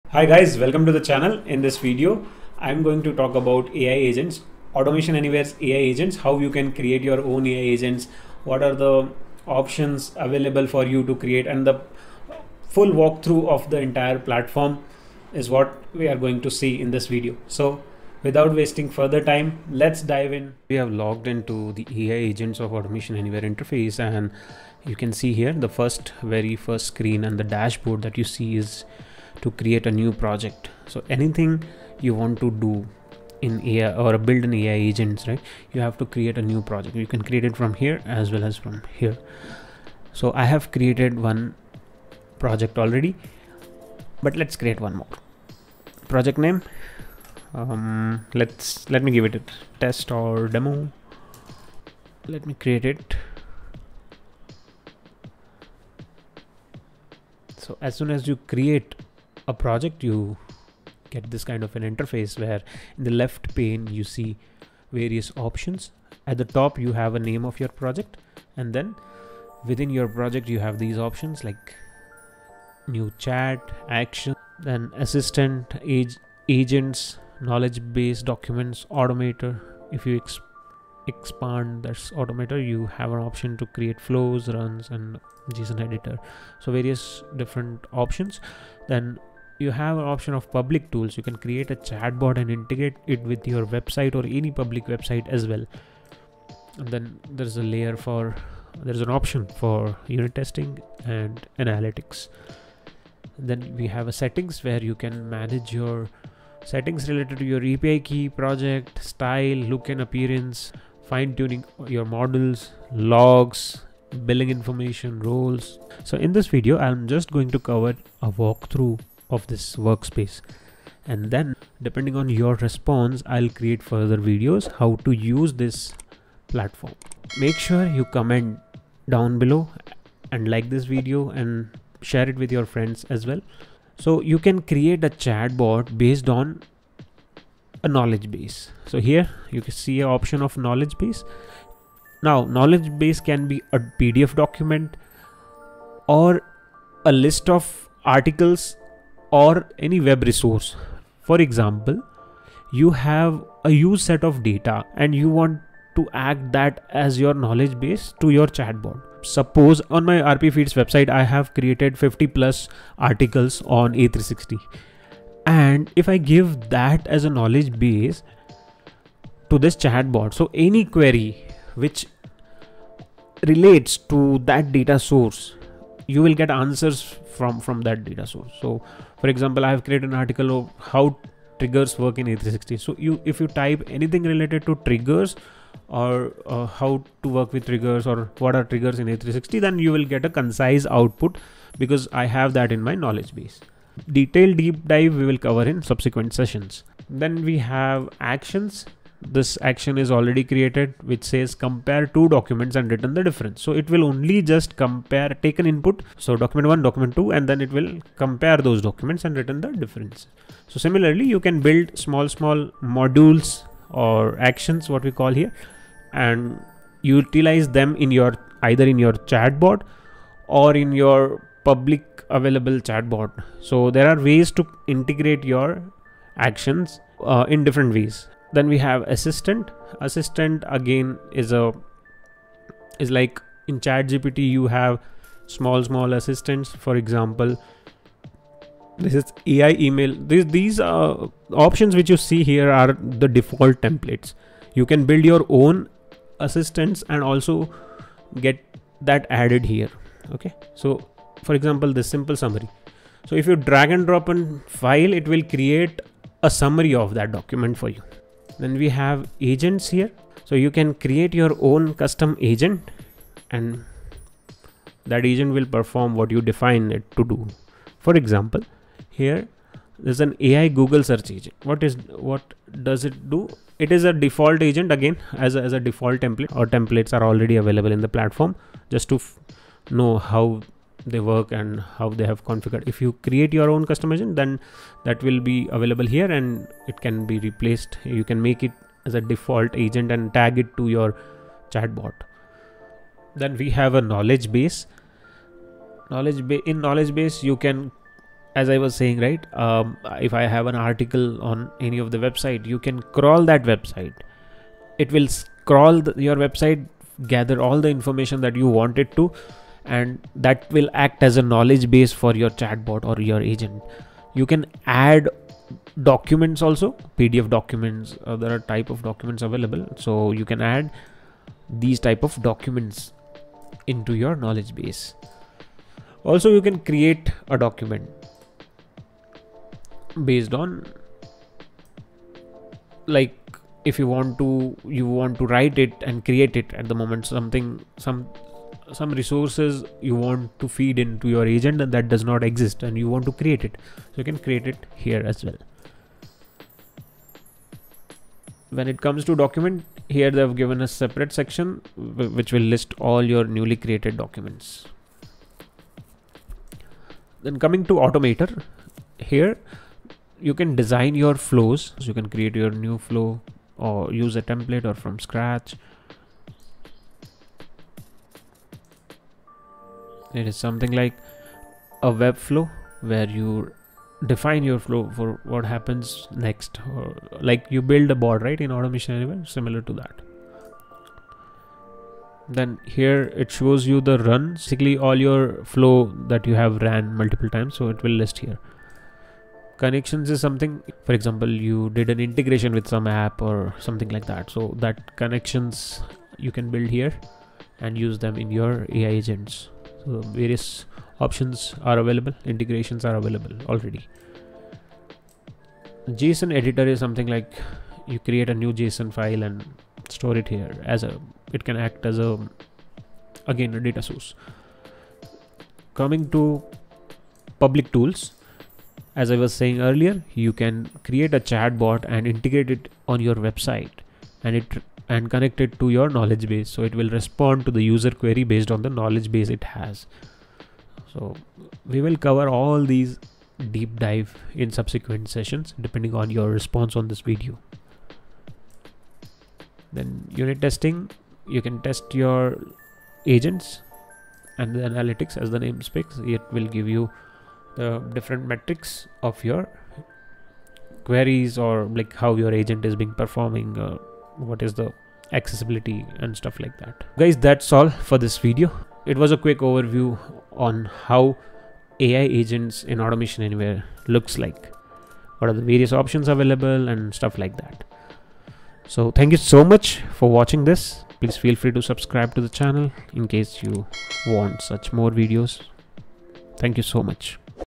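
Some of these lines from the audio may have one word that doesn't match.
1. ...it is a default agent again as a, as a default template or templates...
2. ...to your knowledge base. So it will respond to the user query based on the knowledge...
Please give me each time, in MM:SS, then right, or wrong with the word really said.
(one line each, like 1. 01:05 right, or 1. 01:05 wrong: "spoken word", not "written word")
1. 04:33 right
2. 07:05 right.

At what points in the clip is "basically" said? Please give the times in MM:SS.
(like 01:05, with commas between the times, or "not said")
06:24.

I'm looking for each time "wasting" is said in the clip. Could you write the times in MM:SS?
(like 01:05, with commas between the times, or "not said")
00:18.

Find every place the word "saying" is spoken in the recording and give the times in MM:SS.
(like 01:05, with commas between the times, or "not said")
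04:58, 06:59.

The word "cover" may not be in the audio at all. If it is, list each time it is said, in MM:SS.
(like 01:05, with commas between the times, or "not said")
01:57, 03:15, 07:12.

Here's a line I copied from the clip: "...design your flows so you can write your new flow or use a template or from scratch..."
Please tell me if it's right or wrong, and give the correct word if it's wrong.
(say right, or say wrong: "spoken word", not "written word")
wrong: "create", not "write".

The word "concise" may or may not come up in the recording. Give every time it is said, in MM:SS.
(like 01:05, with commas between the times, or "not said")
03:10.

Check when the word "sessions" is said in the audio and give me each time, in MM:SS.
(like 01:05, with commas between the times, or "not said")
03:16, 07:15.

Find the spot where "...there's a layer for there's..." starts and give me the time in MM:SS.
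01:37.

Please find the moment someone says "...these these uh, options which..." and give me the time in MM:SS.
04:00.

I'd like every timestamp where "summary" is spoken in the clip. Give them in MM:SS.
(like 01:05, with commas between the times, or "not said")
04:12, 04:16.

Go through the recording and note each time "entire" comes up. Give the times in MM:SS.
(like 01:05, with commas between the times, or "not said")
00:13.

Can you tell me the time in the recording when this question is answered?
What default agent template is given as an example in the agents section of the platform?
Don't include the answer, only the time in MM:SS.
04:30.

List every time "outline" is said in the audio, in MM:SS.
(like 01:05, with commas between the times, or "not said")
not said.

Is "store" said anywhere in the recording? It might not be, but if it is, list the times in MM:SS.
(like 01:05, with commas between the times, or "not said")
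06:50.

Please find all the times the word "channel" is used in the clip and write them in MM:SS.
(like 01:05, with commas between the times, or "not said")
00:00, 07:52.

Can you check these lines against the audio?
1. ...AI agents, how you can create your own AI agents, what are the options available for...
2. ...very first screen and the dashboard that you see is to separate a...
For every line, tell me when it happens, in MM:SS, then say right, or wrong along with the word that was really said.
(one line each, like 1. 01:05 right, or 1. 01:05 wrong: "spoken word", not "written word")
1. 00:05 right
2. 00:26 wrong: "create", not "separate".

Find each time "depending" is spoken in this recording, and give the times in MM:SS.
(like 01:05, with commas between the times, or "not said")
02:01, 07:15.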